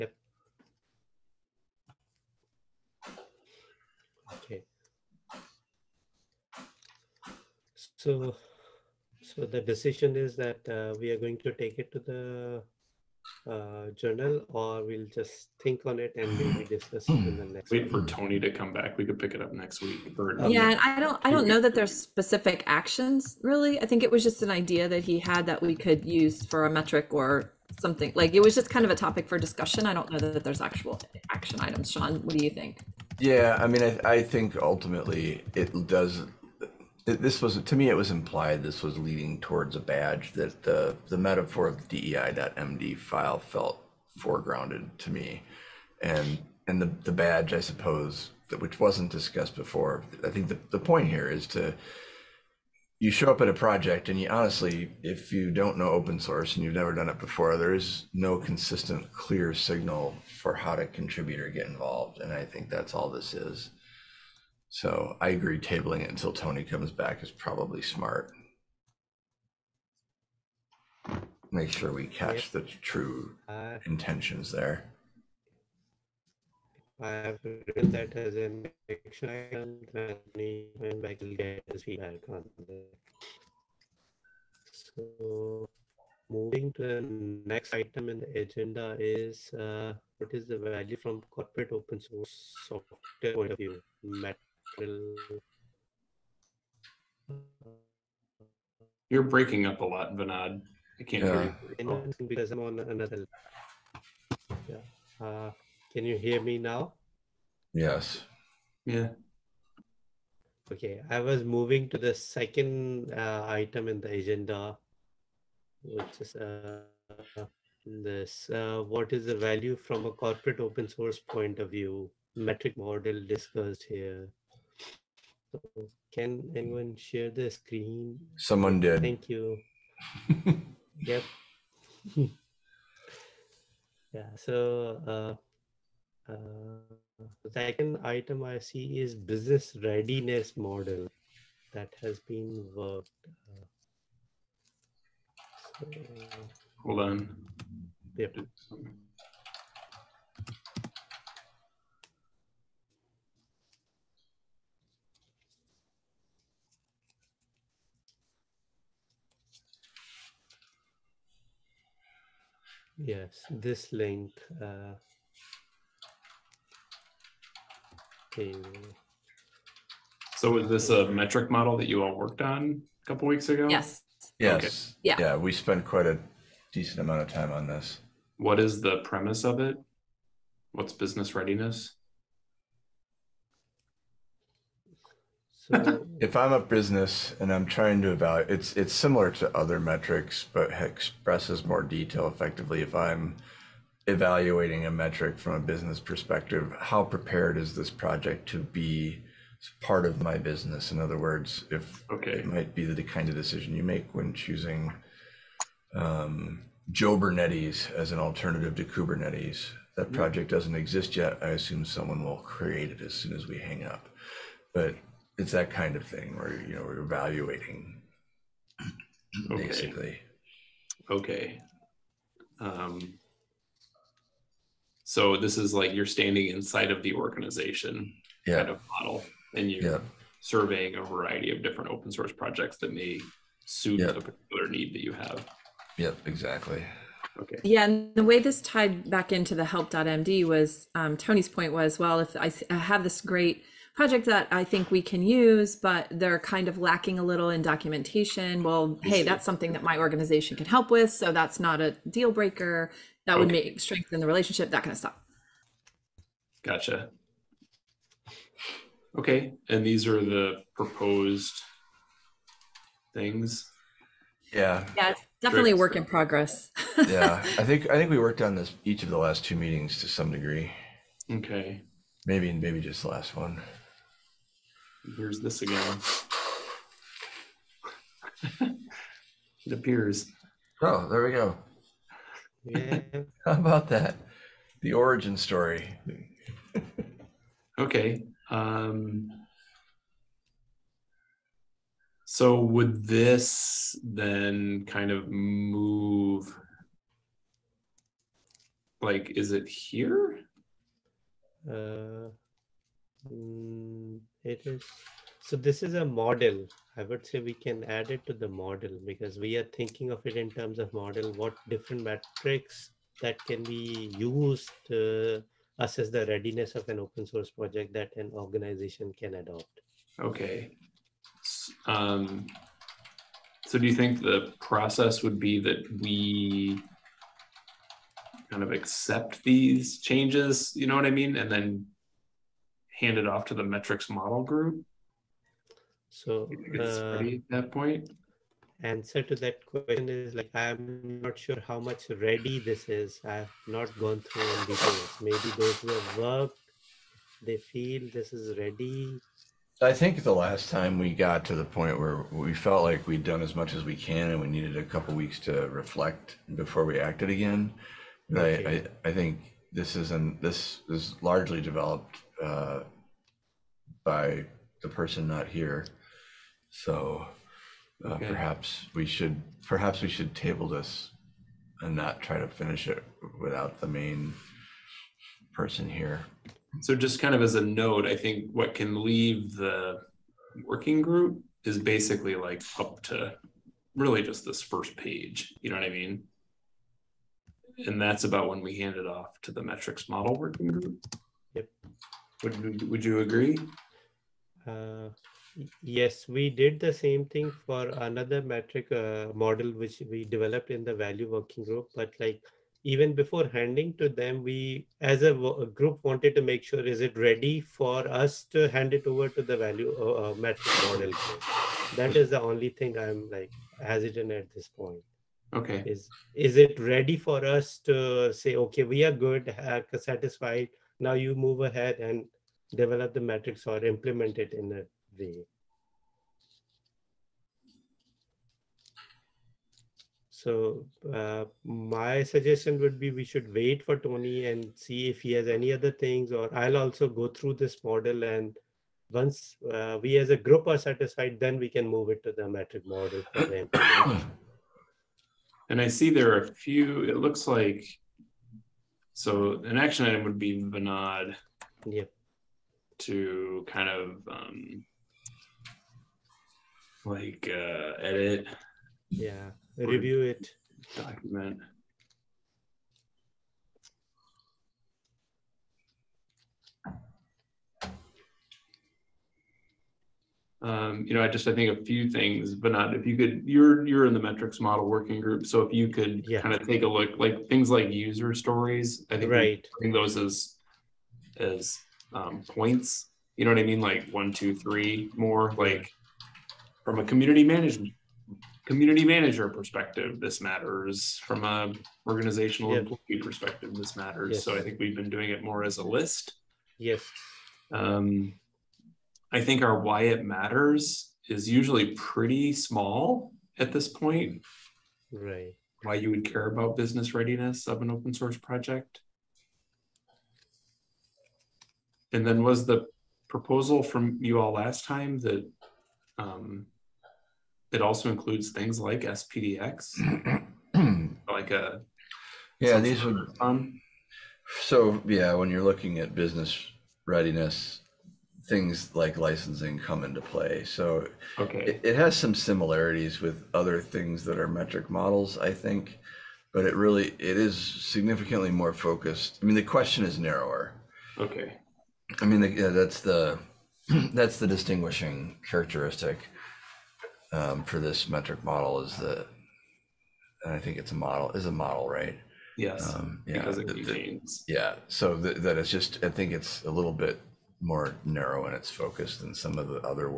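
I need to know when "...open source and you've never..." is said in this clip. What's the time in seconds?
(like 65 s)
55 s.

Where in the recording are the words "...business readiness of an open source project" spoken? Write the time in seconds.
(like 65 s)
506 s.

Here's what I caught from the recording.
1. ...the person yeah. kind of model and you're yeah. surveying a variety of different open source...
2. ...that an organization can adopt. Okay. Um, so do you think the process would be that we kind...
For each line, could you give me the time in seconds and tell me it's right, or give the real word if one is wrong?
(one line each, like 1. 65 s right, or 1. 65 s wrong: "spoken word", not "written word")
1. 227 s wrong: "organization", not "person"
2. 317 s right.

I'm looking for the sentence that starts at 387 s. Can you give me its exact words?
And that's about when we hand it off to the metrics model working group.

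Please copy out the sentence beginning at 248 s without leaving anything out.
Well, hey, that's something that my organization can help with.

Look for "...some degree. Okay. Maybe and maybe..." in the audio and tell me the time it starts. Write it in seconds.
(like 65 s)
270 s.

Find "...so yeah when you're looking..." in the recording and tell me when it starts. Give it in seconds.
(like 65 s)
524 s.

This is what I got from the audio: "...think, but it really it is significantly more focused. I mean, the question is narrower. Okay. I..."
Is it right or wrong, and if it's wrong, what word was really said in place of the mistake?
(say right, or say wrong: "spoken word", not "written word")
right.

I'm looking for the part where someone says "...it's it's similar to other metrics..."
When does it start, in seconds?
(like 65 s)
188 s.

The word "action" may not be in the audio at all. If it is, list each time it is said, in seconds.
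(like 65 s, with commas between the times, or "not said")
22 s, 31 s, 78 s, 449 s.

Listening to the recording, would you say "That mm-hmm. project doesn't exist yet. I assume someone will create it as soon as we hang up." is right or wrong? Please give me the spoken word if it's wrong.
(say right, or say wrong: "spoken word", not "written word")
right.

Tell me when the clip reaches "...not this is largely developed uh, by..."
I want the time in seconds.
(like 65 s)
360 s.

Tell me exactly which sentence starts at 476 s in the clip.
kind of take a look, like things like user stories, I think right.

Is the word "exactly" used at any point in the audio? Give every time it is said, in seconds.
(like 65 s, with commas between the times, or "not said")
236 s.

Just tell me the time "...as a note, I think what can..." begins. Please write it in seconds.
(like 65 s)
377 s.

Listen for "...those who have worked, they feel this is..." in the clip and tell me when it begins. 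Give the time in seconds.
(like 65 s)
345 s.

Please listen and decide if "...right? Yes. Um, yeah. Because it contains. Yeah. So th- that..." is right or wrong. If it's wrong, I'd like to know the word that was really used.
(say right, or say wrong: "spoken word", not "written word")
right.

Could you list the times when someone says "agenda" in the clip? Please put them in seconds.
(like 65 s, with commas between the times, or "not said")
88 s, 114 s.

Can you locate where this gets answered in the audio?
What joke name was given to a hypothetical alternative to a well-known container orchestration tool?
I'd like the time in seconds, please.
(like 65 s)
206 s.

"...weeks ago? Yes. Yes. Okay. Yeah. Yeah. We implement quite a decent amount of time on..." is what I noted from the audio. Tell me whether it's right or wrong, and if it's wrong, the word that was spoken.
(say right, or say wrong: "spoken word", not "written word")
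wrong: "spent", not "implement".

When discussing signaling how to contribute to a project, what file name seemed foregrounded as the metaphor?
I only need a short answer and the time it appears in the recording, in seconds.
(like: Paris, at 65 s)
dei.md, at 42 s.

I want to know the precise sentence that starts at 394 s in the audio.
Uh, yes, we did the same thing for another metric uh, model, which we developed in the value working group.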